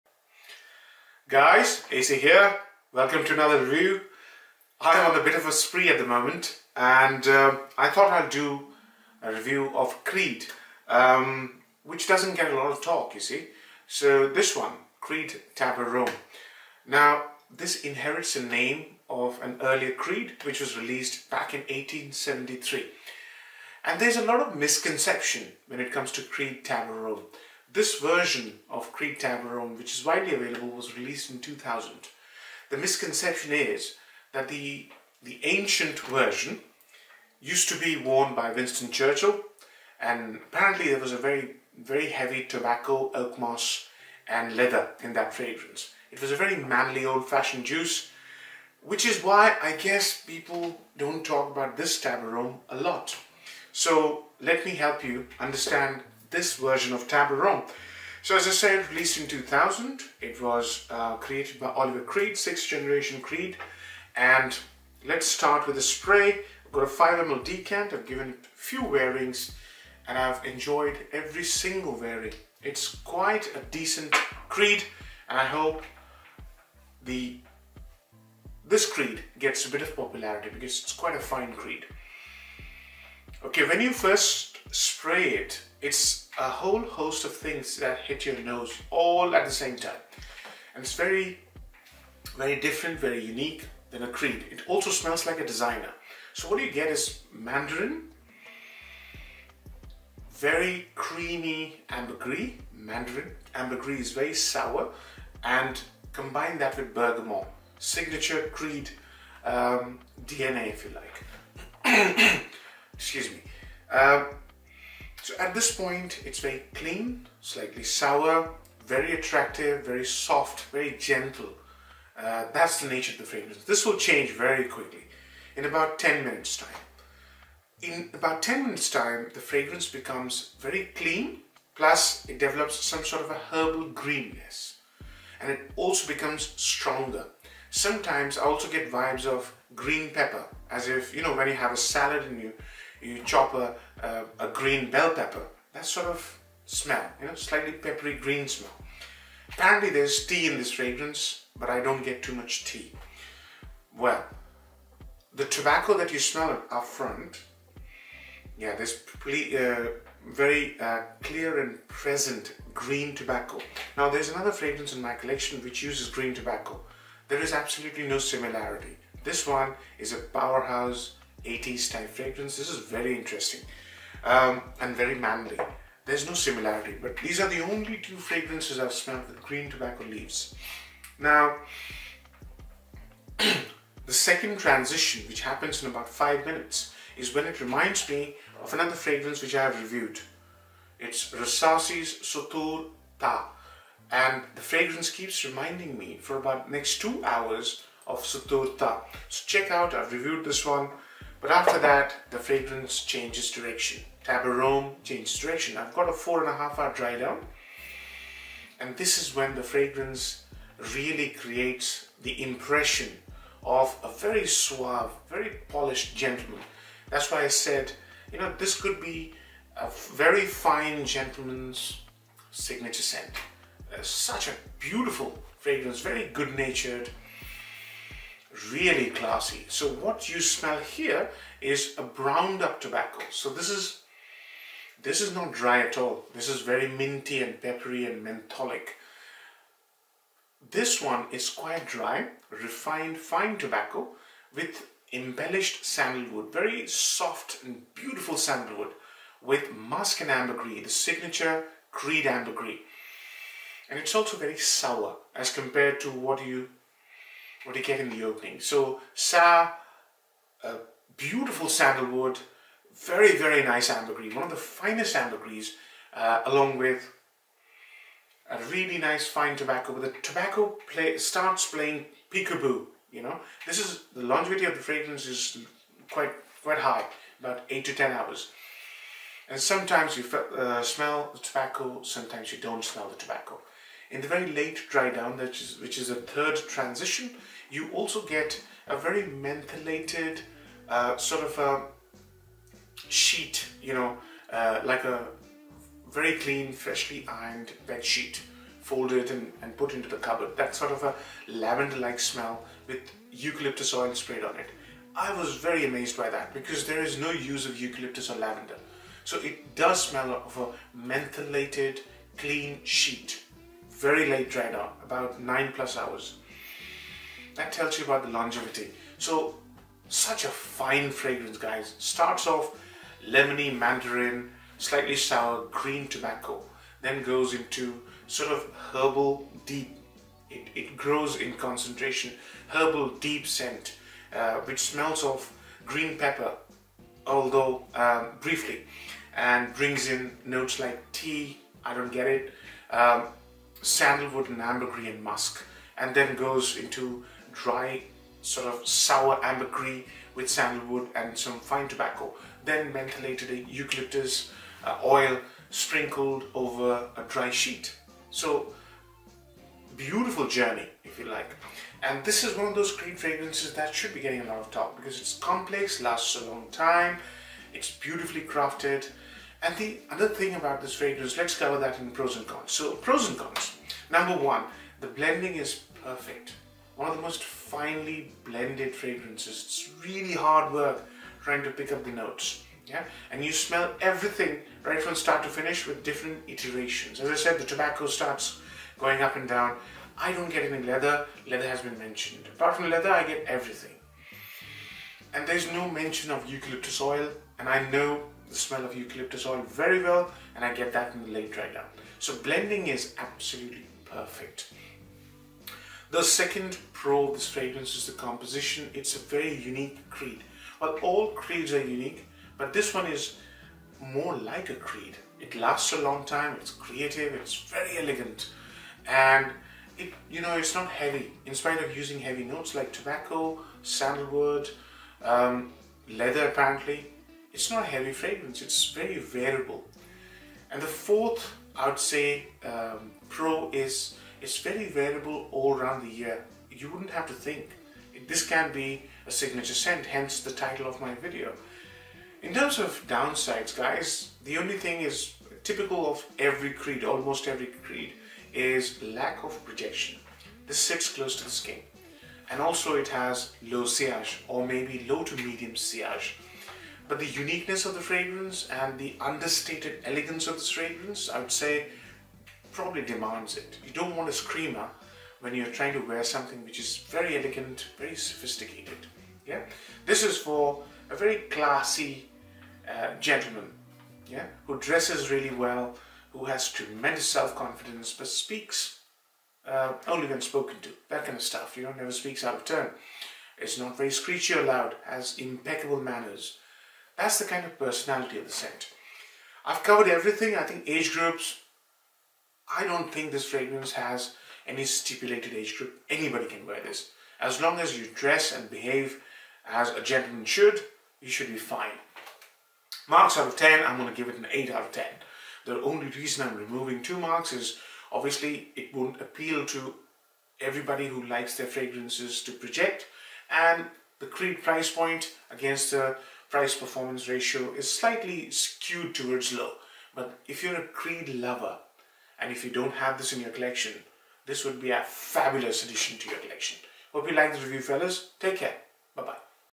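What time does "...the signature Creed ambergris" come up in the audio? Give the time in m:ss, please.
4:10.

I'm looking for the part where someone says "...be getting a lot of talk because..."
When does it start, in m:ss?
6:04.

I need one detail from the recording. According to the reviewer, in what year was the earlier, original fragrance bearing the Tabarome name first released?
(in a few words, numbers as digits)
1873.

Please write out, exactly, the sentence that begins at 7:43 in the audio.
You don't want a screamer when you're trying to wear something which is very elegant, very sophisticated.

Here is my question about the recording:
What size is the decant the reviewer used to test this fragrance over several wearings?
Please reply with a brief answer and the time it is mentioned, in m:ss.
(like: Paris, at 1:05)
5 ml, at 1:06.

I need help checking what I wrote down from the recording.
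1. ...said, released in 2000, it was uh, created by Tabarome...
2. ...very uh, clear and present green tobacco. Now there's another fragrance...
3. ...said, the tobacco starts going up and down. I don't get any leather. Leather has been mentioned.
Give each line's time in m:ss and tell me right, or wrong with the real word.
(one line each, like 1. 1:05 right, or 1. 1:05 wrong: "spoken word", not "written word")
1. 0:58 wrong: "Olivier", not "Tabarome"
2. 2:40 right
3. 6:27 right.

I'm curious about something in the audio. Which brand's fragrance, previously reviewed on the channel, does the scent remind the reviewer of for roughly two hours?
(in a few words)
Rasasi.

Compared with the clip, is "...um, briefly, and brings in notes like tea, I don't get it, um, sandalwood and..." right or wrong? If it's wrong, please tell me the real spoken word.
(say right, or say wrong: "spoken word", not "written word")
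right.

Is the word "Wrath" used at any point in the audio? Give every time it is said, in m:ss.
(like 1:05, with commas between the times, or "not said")
not said.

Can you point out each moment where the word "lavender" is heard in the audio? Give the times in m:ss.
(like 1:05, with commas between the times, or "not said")
5:01, 5:08.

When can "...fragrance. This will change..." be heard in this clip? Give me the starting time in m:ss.
2:03.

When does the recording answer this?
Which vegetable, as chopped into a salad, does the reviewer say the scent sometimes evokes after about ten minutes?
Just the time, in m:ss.
2:24.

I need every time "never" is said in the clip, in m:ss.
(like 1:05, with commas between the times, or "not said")
8:01.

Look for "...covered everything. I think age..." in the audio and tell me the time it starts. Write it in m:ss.
8:09.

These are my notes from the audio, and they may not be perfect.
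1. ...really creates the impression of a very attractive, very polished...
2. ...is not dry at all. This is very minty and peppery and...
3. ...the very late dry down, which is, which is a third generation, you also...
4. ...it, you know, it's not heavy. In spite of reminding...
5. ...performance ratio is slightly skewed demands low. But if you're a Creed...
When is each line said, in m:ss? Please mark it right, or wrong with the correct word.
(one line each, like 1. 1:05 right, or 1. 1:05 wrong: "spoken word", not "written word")
1. 3:30 wrong: "suave", not "attractive"
2. 3:55 right
3. 4:44 wrong: "transition", not "generation"
4. 6:59 wrong: "using", not "reminding"
5. 8:36 wrong: "towards", not "demands".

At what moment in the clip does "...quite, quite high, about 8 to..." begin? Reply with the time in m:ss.
4:36.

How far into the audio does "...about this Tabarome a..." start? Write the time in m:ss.
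0:51.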